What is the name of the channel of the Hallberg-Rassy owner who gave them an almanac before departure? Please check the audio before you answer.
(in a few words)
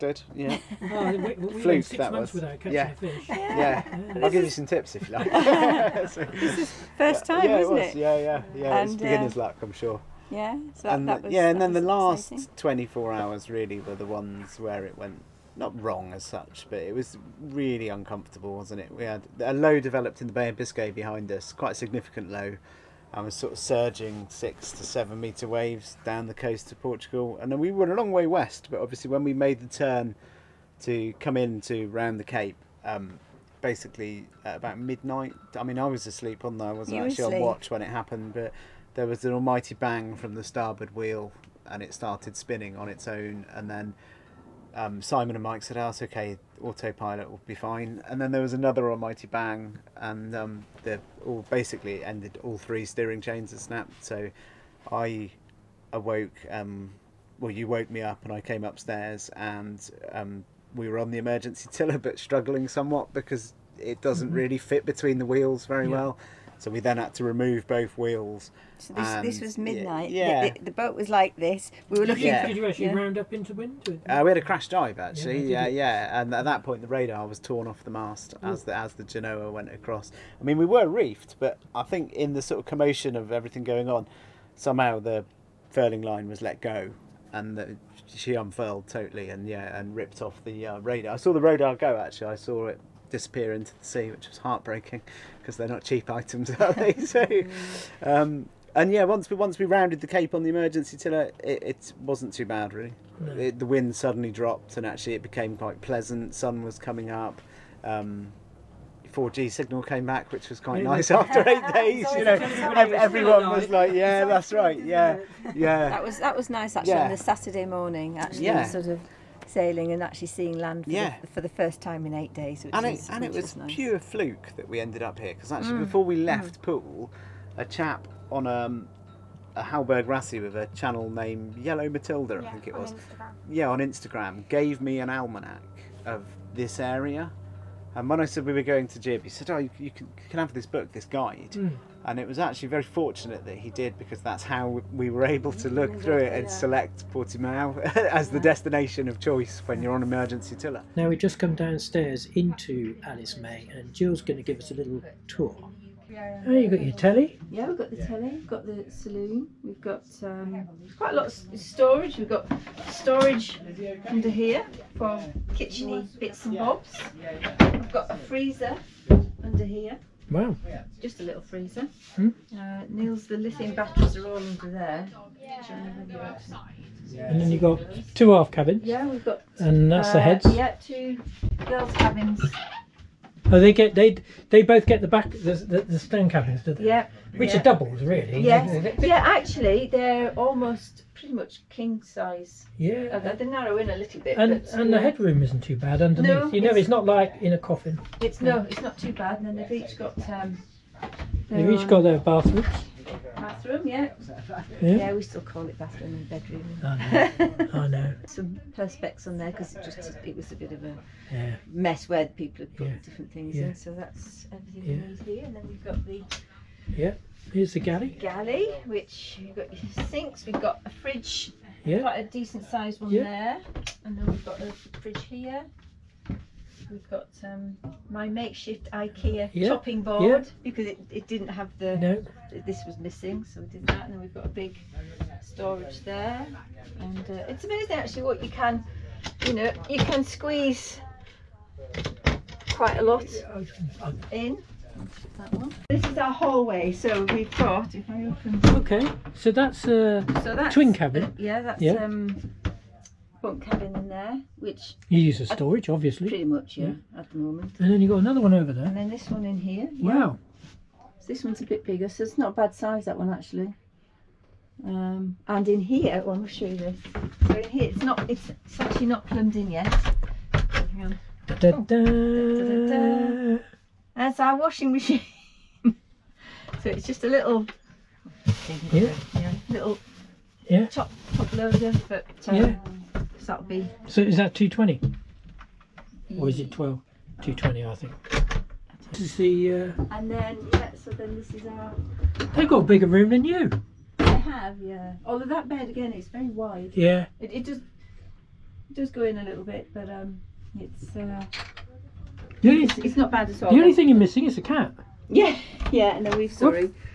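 Yellow Matilda.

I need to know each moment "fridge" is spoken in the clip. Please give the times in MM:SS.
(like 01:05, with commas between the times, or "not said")
03:40, 03:45.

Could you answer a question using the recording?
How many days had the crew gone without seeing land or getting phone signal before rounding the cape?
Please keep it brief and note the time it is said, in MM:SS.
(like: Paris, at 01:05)
8, at 02:02.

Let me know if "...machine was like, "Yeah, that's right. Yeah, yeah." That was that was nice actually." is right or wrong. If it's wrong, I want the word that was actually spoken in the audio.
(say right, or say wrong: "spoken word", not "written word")
wrong: "everyone", not "machine".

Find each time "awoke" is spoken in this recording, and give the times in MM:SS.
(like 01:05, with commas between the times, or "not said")
00:55.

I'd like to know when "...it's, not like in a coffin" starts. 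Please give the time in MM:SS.
03:16.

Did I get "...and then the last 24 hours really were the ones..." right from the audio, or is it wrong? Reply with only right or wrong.
right.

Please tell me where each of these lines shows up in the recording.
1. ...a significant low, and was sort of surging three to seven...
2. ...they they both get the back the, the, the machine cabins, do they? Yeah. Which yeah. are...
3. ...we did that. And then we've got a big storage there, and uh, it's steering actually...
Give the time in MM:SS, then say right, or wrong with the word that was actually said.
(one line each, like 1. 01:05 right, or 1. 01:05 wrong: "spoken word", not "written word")
1. 00:21 wrong: "six", not "three"
2. 03:03 wrong: "stone", not "machine"
3. 03:53 wrong: "amazing", not "steering".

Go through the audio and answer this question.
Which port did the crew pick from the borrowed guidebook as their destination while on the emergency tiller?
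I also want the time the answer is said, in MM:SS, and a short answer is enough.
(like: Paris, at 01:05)
Portimao, at 02:27.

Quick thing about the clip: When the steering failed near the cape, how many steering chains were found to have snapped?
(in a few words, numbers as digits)
3.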